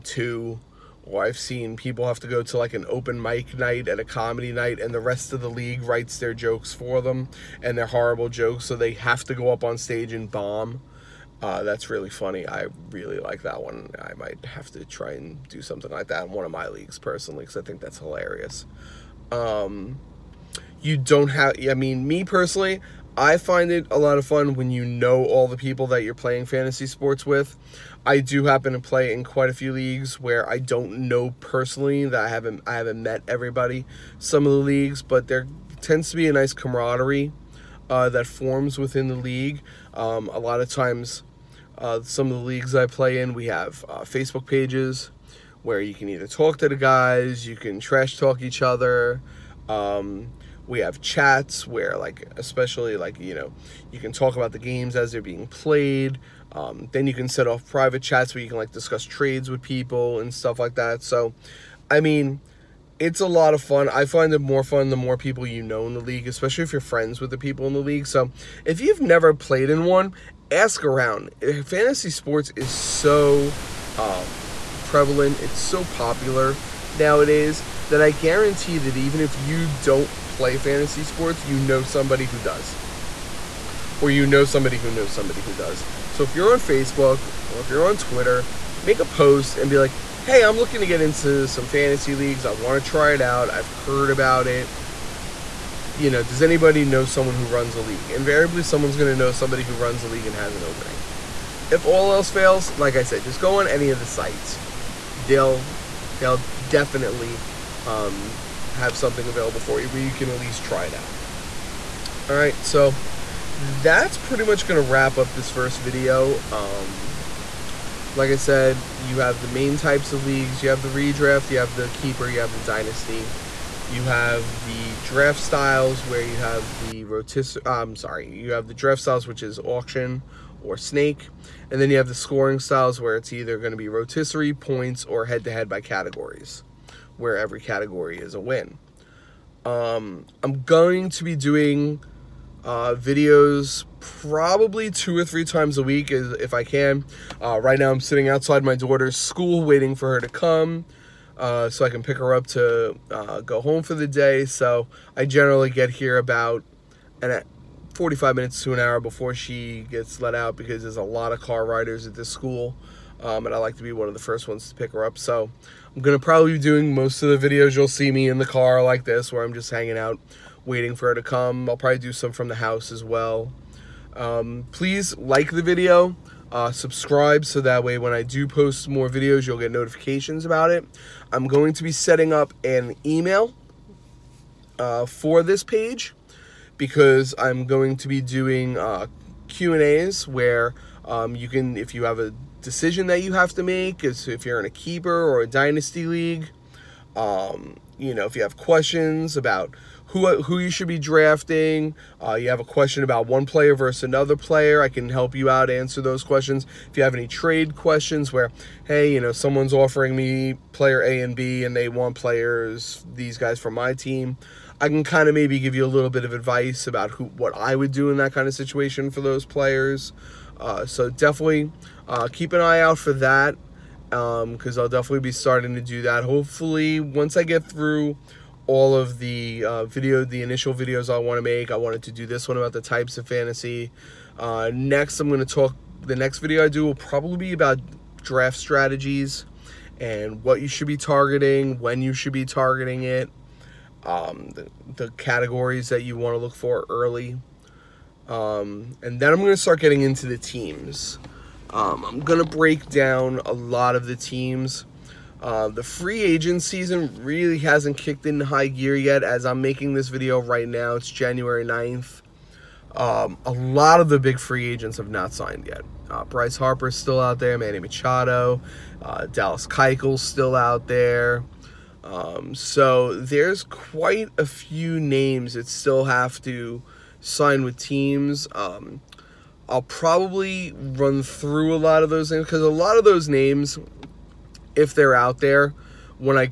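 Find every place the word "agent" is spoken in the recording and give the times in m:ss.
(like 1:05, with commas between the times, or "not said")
4:16, 4:24.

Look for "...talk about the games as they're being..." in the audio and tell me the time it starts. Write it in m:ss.
0:54.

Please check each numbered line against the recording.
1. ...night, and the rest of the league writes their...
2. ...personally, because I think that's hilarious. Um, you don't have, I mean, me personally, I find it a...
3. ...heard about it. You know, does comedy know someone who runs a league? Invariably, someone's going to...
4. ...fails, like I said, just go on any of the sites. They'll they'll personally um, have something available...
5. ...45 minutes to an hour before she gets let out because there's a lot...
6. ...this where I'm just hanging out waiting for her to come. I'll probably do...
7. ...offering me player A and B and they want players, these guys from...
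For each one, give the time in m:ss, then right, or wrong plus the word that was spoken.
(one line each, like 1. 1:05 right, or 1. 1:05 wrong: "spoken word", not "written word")
1. 0:04 right
2. 0:16 right
3. 1:33 wrong: "anybody", not "comedy"
4. 1:42 wrong: "definitely", not "personally"
5. 2:37 right
6. 2:49 right
7. 3:29 right.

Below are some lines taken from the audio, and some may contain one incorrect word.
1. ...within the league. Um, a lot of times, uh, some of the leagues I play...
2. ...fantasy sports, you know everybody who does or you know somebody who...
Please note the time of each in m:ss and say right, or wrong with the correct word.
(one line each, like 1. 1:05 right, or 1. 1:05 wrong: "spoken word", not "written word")
1. 0:38 right
2. 1:20 wrong: "somebody", not "everybody".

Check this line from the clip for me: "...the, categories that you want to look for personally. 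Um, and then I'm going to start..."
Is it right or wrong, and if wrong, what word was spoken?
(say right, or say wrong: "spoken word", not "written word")
wrong: "early", not "personally".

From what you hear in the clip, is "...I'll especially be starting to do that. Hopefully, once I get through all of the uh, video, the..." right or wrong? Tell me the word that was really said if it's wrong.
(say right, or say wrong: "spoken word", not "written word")
wrong: "definitely", not "especially".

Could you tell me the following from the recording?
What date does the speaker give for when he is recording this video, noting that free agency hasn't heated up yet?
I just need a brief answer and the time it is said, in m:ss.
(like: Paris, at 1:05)
January 9th, at 4:21.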